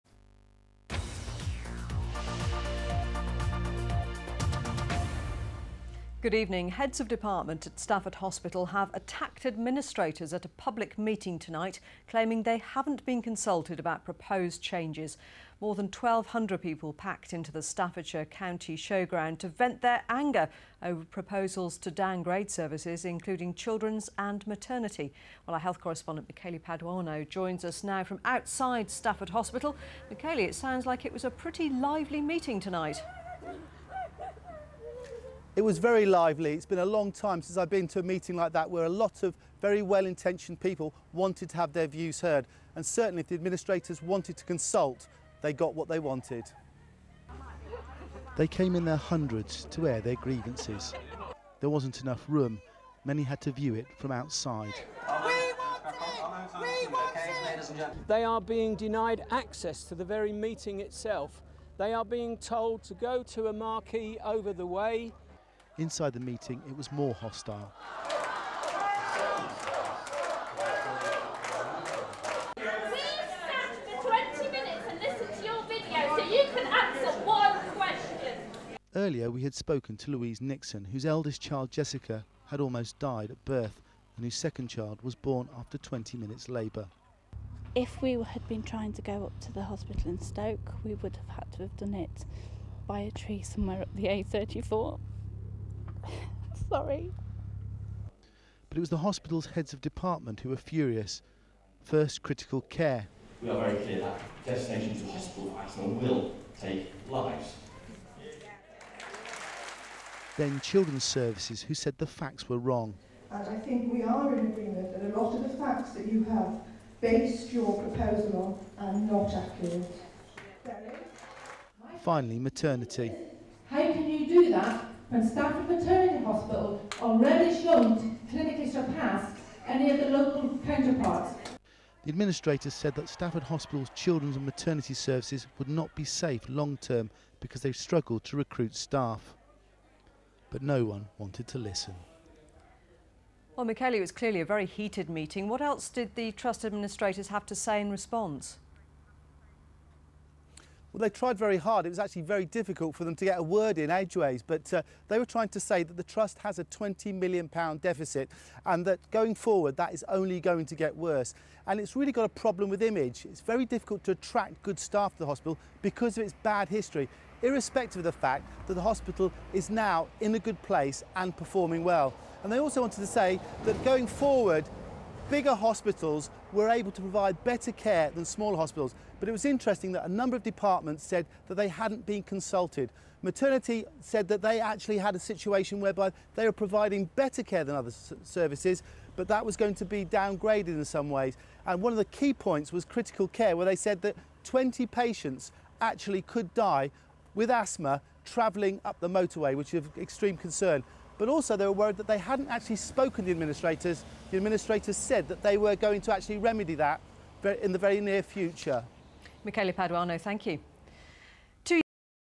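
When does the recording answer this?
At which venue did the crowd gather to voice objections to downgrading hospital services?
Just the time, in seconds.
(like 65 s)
17 s.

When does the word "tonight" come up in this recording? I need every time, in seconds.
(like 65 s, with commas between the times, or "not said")
11 s, 32 s.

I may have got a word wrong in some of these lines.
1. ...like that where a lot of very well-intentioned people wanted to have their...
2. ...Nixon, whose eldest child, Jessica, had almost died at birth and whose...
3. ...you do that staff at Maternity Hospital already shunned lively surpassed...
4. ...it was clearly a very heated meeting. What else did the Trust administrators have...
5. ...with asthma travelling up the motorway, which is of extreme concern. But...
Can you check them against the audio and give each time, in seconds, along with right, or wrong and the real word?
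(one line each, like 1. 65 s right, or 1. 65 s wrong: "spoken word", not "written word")
1. 38 s right
2. 80 s right
3. 124 s wrong: "clinically", not "lively"
4. 143 s right
5. 197 s right.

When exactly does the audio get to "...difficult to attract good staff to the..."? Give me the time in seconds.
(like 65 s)
163 s.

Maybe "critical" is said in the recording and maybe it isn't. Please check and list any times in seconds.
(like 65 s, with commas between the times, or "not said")
102 s, 192 s.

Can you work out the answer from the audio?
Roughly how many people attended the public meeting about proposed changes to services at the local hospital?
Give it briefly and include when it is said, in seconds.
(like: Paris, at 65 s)
More than 1,200, at 15 s.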